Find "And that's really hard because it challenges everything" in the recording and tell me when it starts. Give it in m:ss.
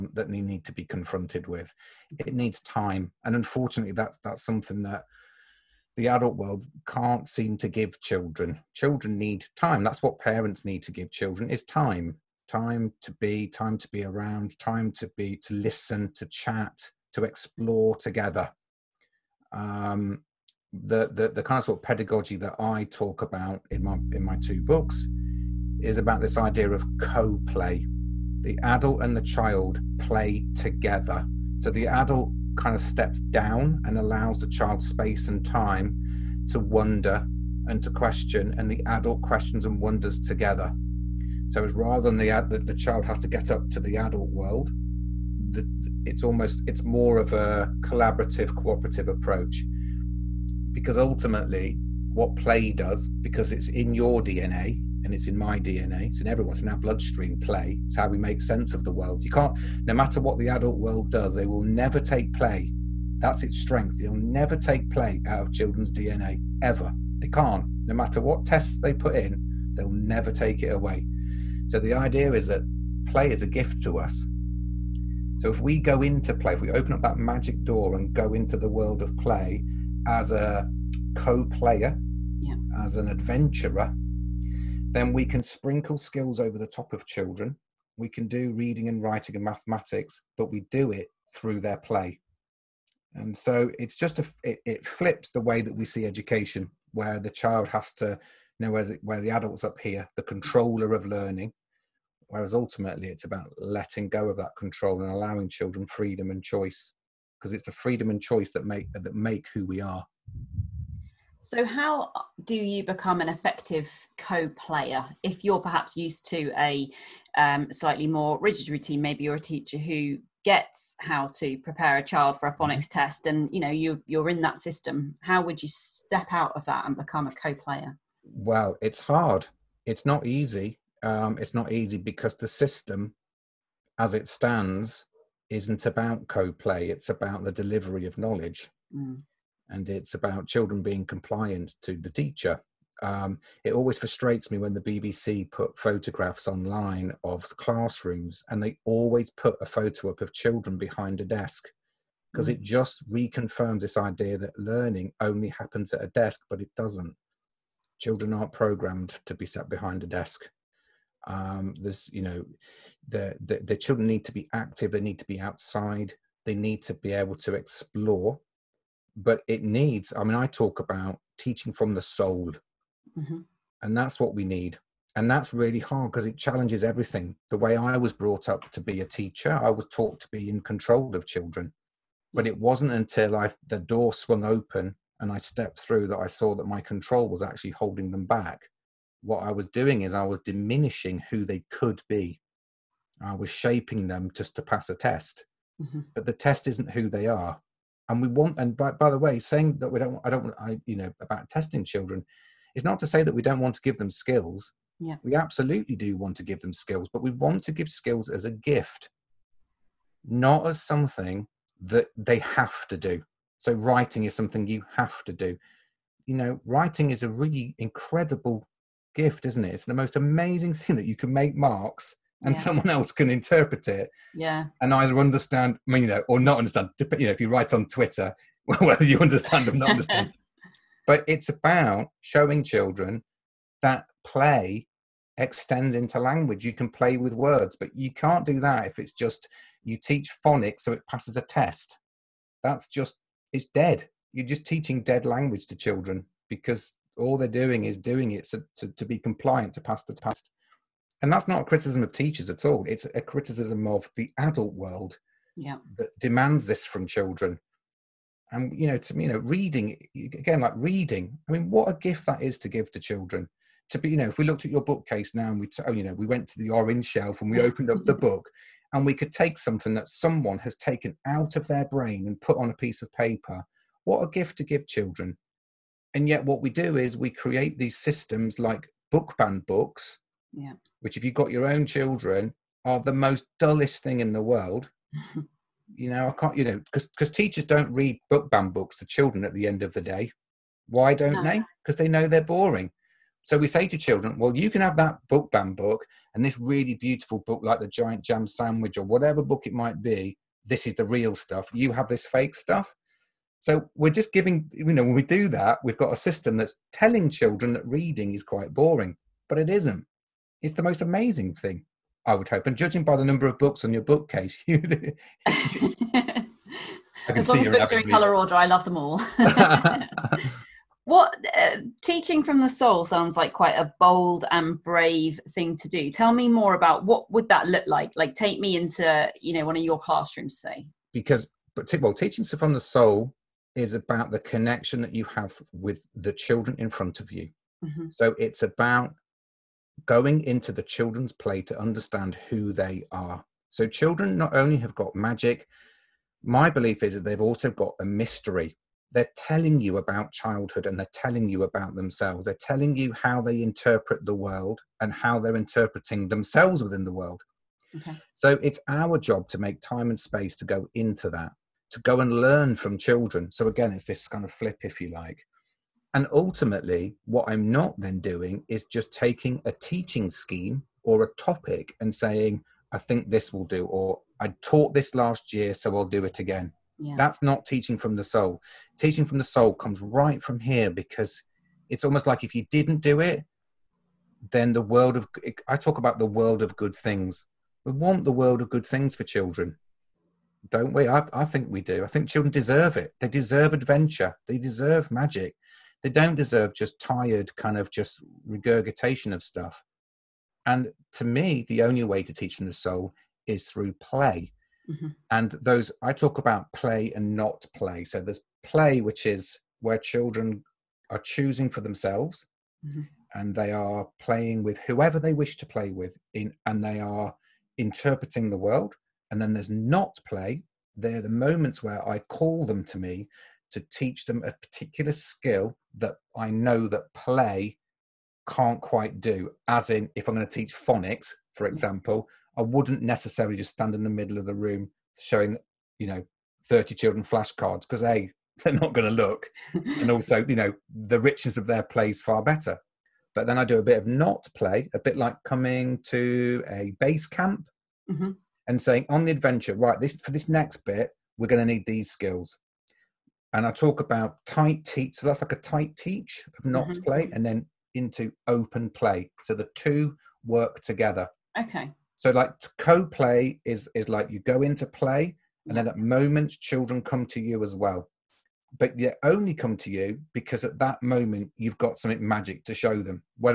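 2:55.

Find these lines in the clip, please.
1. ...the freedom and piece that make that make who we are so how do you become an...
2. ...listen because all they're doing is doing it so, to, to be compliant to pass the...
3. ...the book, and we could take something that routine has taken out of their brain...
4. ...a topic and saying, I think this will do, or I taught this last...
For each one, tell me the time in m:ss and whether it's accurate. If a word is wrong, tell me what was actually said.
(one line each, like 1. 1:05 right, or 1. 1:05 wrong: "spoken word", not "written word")
1. 1:47 wrong: "choice", not "piece"
2. 4:05 wrong: "children", not "listen"
3. 4:28 wrong: "someone", not "routine"
4. 6:11 right.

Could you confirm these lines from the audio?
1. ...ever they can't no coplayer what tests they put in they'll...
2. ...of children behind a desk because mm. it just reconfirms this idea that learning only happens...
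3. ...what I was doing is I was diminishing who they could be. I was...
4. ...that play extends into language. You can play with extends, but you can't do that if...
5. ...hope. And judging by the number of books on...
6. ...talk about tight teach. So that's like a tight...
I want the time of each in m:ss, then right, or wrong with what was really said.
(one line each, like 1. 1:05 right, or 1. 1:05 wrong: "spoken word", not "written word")
1. 1:06 wrong: "matter", not "coplayer"
2. 2:30 right
3. 3:09 right
4. 3:53 wrong: "words", not "extends"
5. 5:12 right
6. 7:33 right.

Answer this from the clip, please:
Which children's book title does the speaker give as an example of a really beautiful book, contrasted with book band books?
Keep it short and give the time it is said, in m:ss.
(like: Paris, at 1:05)
The Giant Jam Sandwich, at 4:57.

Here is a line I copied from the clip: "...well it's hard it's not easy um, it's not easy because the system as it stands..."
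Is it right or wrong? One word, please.
right.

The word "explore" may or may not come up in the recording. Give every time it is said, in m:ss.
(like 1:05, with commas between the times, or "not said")
0:17, 2:47.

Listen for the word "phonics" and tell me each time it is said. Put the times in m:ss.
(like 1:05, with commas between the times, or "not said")
2:02, 4:00, 7:10.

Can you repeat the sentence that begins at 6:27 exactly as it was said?
We want the world of good things for children don't we?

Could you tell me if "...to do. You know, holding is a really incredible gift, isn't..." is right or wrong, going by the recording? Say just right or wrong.
wrong.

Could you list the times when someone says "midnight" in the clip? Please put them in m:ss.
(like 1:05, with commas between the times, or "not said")
not said.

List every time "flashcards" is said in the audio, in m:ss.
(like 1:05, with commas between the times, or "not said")
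7:17.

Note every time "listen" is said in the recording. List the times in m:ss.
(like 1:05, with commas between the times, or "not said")
0:15.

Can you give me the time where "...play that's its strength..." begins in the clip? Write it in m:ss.
1:02.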